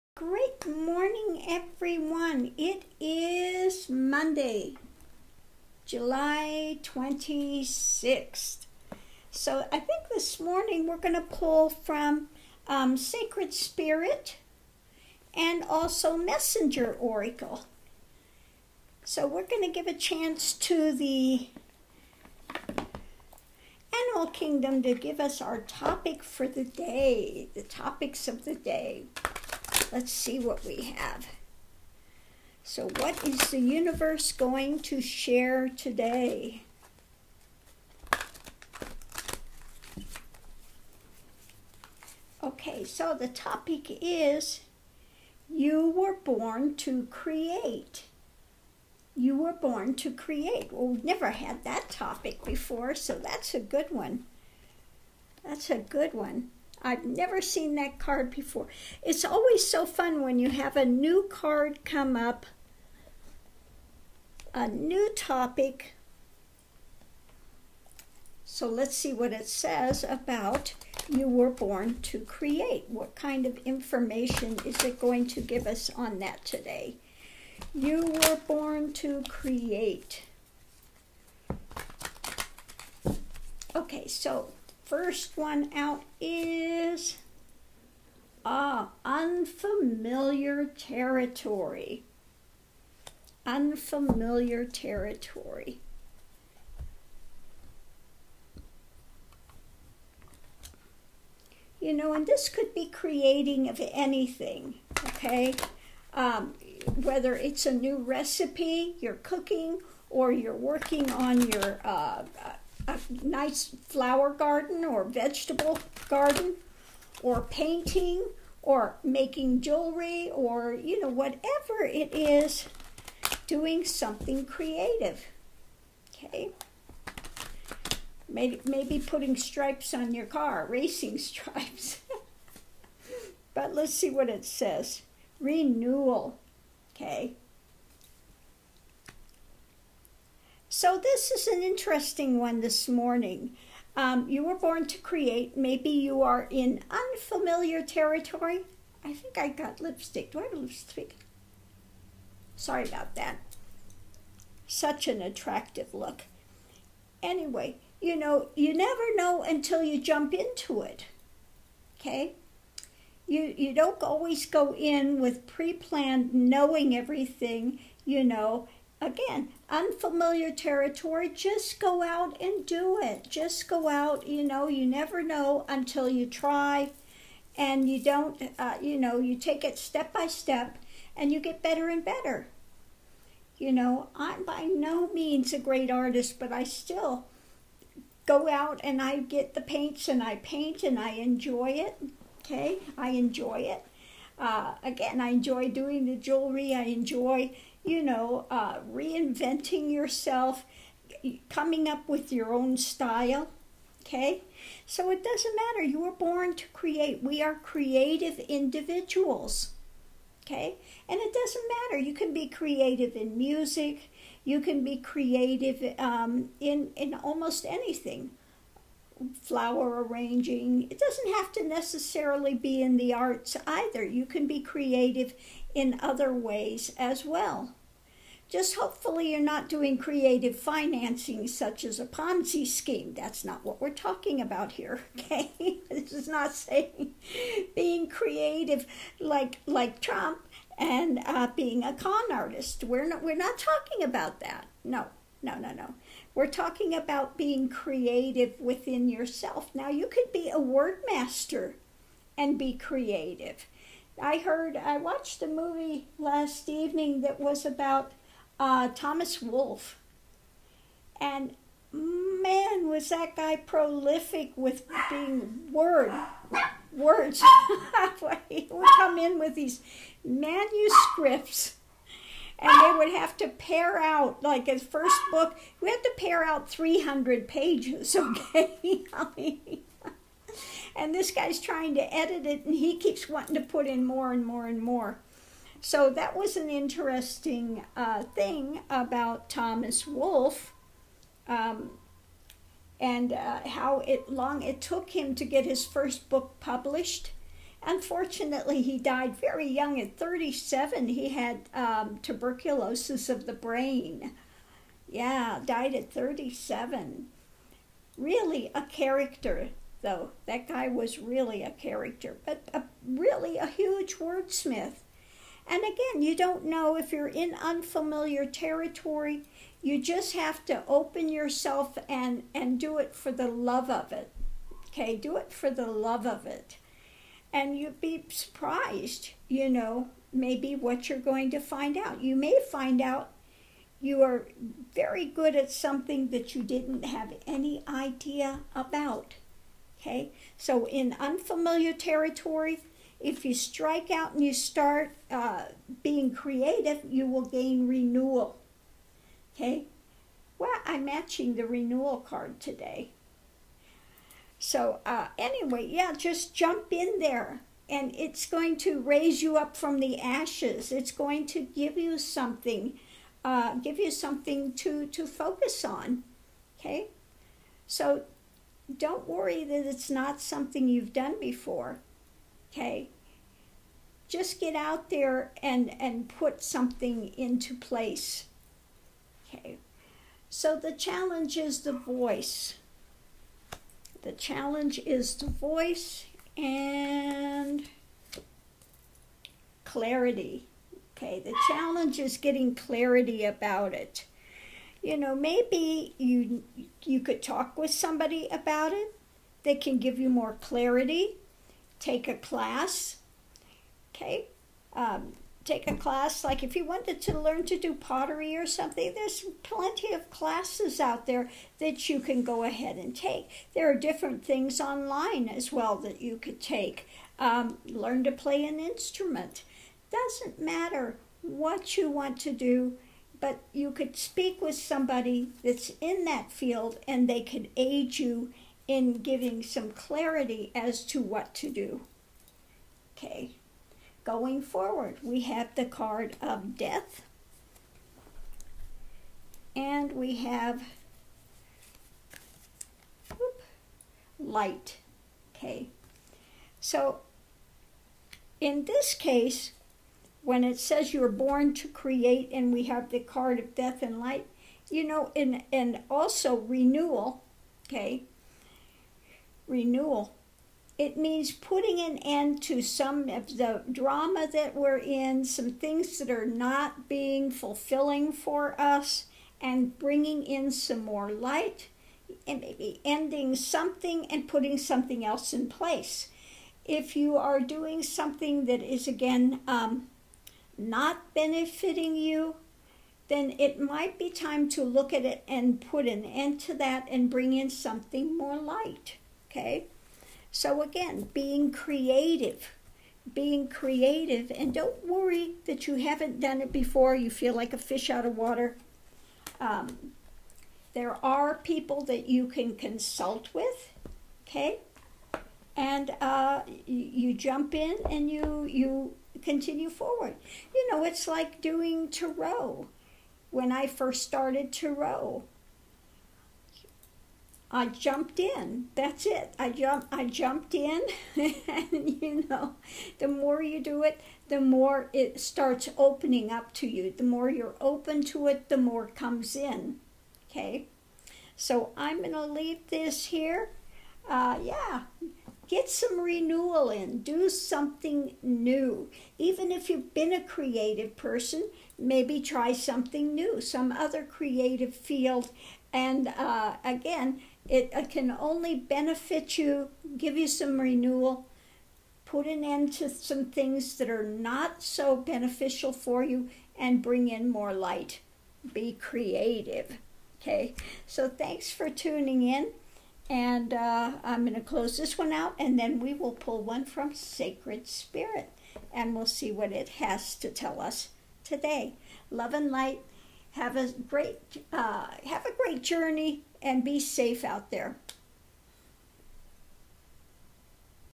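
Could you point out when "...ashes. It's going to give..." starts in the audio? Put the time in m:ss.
6:00.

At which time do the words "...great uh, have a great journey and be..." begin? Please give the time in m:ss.
9:34.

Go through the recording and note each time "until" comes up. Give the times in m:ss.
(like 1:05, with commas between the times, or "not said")
2:39, 2:55.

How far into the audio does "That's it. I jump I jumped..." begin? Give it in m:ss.
8:38.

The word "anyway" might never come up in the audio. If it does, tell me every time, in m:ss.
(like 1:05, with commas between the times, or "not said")
2:37, 5:55.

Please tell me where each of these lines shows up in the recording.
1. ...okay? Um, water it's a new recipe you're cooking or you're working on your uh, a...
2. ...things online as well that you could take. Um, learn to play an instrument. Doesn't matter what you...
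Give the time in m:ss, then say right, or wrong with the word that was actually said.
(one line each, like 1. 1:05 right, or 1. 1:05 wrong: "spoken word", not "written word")
1. 1:45 wrong: "whether", not "water"
2. 6:54 right.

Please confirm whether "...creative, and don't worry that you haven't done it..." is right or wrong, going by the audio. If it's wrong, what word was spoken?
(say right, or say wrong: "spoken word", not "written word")
right.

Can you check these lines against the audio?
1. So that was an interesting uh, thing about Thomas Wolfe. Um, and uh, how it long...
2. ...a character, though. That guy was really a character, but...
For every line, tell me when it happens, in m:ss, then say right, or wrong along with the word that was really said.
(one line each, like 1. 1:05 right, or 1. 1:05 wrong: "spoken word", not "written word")
1. 4:45 right
2. 5:08 right.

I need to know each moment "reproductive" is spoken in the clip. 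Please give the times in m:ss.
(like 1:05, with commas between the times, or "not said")
not said.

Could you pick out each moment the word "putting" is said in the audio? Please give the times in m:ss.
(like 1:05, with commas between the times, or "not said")
2:08, 7:41, 7:54.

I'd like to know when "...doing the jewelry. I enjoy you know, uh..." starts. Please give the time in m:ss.
3:15.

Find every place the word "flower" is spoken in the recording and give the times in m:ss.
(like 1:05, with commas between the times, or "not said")
1:53, 3:39.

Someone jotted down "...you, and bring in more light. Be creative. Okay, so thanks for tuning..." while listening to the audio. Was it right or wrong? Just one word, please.
right.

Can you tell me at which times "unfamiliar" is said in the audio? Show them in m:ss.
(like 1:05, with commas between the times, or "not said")
1:29, 1:33, 2:26, 2:49, 5:17, 5:41.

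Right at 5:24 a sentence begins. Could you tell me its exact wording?
Okay, do it for the love of it and you'd be surprised, you know, maybe what you're going to find out.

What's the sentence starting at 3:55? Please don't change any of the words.
this is not saying being creative like, like Trump and uh, being a con artist.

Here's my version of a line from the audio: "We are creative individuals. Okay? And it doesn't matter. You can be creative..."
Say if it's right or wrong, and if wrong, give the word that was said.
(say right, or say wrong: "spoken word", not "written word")
right.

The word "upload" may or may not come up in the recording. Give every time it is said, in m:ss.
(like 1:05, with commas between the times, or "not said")
not said.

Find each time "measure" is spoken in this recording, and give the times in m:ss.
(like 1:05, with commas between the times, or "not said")
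not said.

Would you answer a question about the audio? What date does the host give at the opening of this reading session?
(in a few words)
July 26th.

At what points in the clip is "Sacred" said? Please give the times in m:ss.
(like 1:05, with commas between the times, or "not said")
0:12, 9:27.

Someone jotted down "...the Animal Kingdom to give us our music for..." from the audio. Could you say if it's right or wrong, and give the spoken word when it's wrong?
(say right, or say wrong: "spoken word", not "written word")
wrong: "topic", not "music".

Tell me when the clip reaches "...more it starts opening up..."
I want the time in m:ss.
8:44.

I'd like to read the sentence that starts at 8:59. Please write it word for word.
Even if you've been a creative person, maybe try something new, some other creative field.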